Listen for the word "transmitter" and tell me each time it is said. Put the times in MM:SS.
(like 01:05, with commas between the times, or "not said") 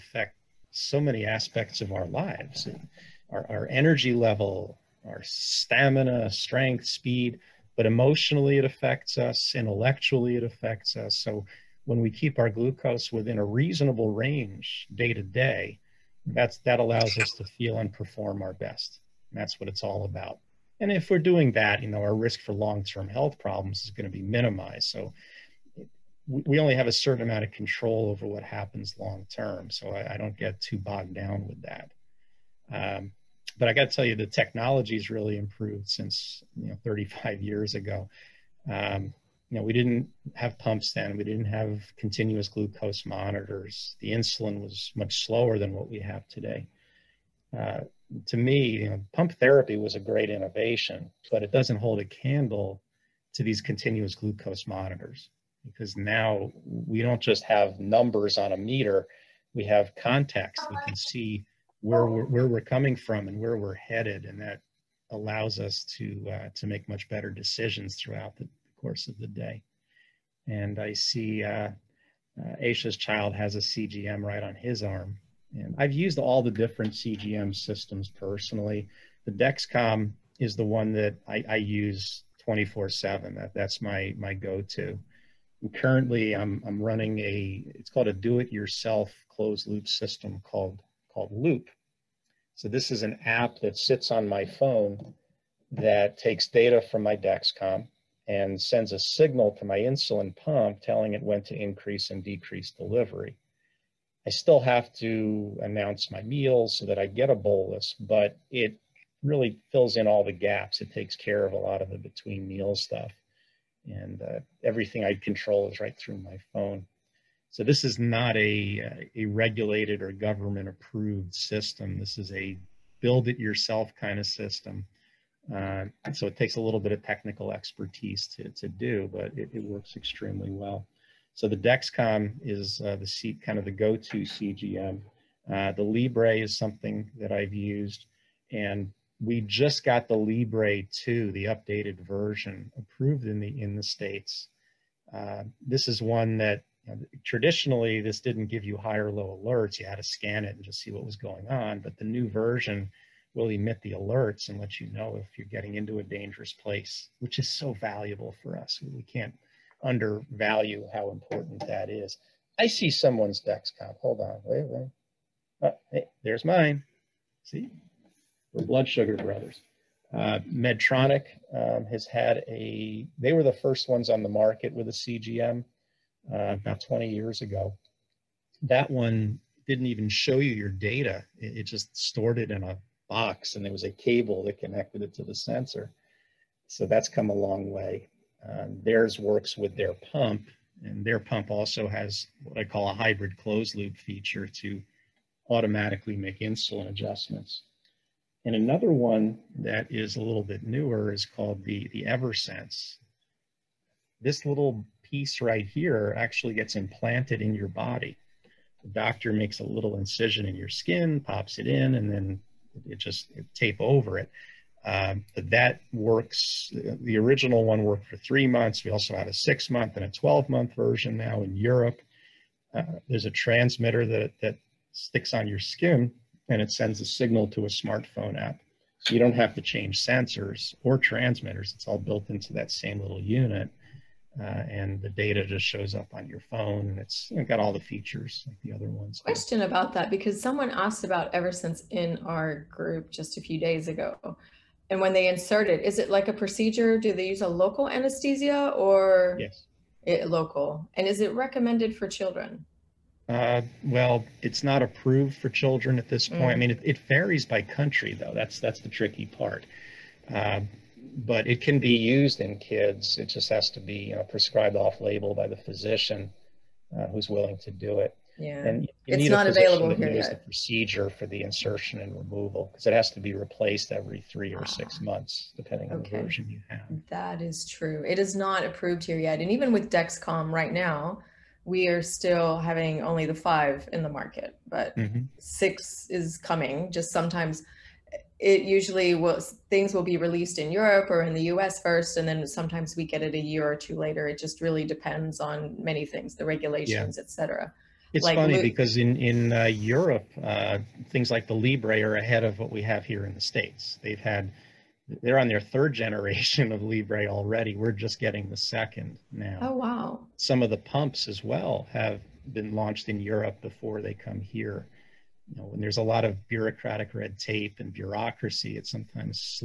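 03:43, 03:50.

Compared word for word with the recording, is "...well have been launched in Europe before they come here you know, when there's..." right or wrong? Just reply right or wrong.
right.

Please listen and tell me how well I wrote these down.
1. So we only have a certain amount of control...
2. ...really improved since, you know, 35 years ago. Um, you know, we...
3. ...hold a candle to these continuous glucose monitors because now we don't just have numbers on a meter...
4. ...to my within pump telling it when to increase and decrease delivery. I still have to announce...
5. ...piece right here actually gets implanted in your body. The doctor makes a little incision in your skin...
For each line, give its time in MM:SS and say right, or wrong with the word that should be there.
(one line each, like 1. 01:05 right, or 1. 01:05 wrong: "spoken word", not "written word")
1. 00:24 right
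2. 00:35 right
3. 00:51 right
4. 01:39 wrong: "insulin", not "within"
5. 03:25 right.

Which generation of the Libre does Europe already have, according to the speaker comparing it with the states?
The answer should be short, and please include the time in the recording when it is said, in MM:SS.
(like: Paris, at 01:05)
third, at 05:05.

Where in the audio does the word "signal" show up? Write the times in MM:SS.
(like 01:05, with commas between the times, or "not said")
01:38, 03:47.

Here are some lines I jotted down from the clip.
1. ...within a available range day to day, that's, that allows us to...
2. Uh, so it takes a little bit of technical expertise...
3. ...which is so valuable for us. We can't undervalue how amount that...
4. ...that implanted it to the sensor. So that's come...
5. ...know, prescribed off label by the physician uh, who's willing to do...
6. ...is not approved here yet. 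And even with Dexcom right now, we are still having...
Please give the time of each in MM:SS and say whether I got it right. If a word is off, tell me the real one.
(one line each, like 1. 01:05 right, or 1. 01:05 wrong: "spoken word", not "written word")
1. 00:13 wrong: "reasonable", not "available"
2. 02:05 right
3. 02:37 wrong: "important", not "amount"
4. 03:04 wrong: "connected", not "implanted"
5. 04:24 right
6. 04:38 right.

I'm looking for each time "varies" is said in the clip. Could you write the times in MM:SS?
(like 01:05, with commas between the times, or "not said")
04:17.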